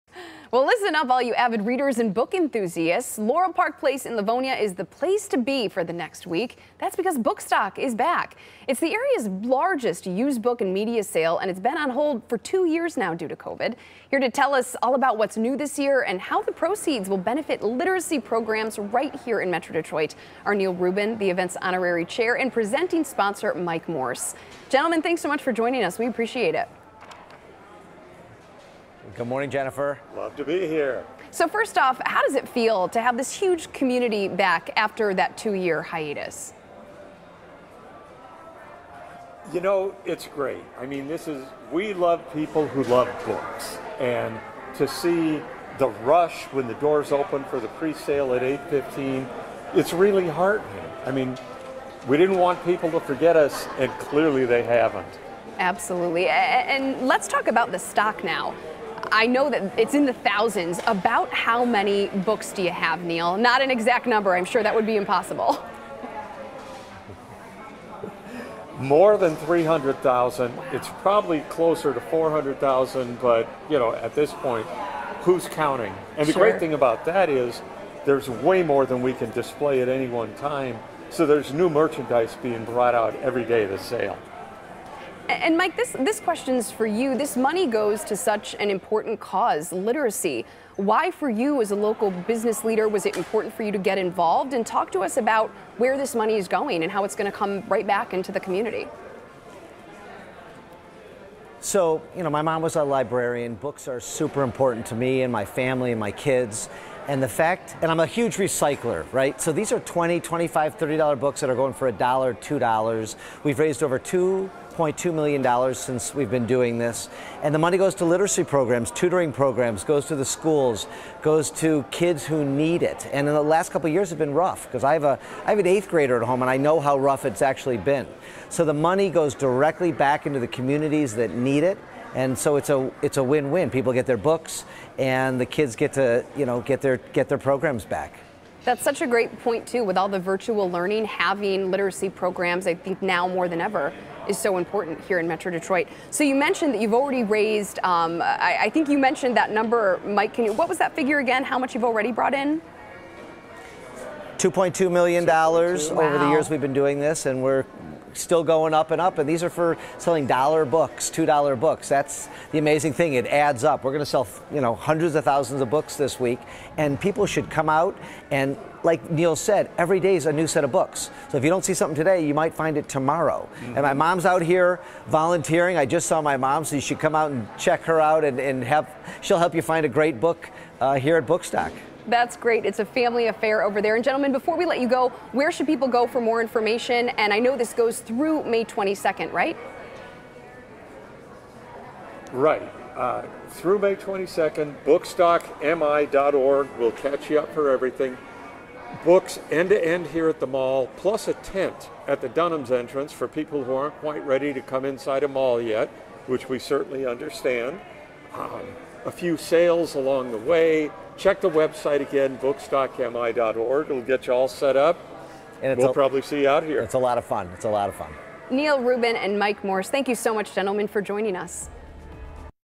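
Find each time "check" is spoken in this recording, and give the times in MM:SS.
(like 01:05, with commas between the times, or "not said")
02:57, 03:31.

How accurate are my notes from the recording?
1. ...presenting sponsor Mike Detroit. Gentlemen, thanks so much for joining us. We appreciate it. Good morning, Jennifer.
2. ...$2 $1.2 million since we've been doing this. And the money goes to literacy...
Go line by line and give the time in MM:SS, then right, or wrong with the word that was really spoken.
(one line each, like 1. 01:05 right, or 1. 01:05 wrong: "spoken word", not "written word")
1. 00:22 wrong: "Morse", not "Detroit"
2. 01:53 right.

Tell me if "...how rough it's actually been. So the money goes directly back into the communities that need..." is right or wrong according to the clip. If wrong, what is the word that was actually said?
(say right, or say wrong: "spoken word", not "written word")
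right.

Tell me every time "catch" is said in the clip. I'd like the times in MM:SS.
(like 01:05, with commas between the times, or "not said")
03:16.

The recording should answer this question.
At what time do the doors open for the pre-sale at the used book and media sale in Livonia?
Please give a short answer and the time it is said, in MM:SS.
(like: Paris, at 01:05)
8:15, at 00:48.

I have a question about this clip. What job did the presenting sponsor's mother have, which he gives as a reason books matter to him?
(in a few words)
Librarian.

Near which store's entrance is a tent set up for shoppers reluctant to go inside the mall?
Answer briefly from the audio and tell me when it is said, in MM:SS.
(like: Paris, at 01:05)
Dunham's, at 03:22.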